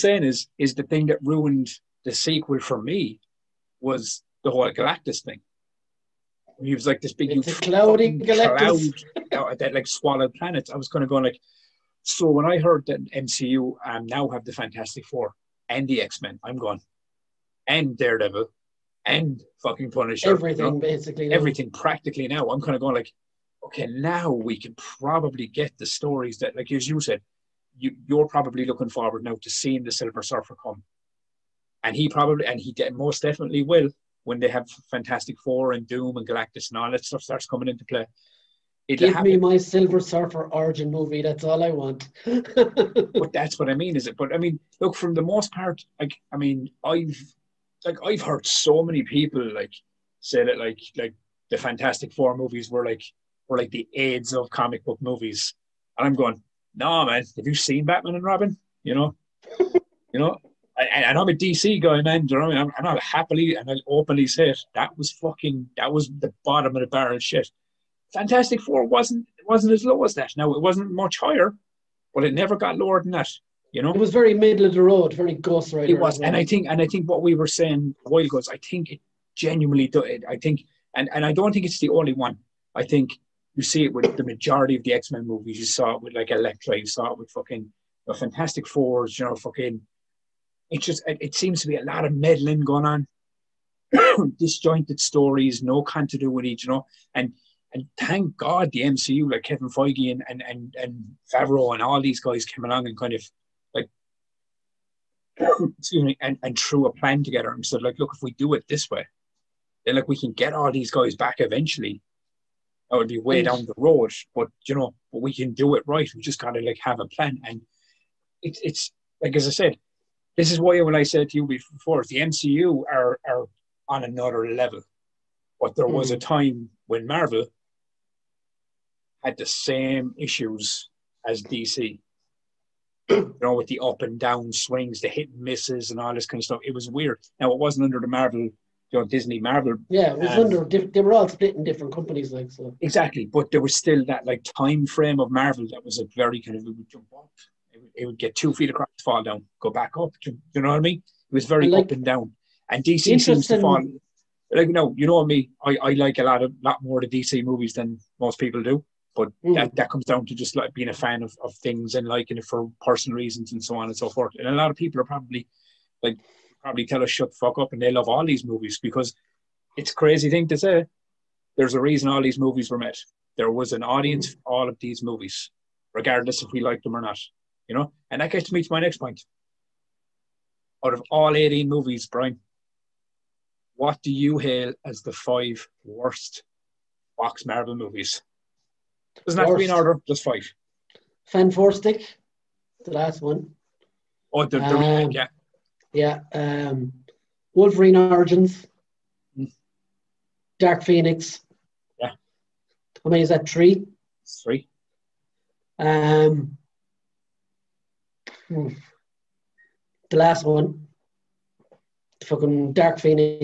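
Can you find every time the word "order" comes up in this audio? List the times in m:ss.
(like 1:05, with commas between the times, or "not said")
3:09.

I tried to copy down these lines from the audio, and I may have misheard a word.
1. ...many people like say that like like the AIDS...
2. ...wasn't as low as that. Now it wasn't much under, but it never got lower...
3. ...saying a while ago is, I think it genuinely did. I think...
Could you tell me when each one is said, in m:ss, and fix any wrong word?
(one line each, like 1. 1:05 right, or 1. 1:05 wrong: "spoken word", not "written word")
1. 0:48 wrong: "Fantastic", not "AIDS"
2. 1:09 wrong: "higher", not "under"
3. 1:17 right.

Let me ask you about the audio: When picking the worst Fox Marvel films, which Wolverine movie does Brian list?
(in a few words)
Wolverine Origins.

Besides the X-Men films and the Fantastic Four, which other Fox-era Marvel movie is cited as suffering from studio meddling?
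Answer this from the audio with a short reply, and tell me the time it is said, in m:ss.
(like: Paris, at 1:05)
Elektra, at 1:26.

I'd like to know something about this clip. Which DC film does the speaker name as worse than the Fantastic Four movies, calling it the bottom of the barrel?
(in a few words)
Batman and Robin.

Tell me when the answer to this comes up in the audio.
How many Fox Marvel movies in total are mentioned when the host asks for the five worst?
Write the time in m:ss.
3:01.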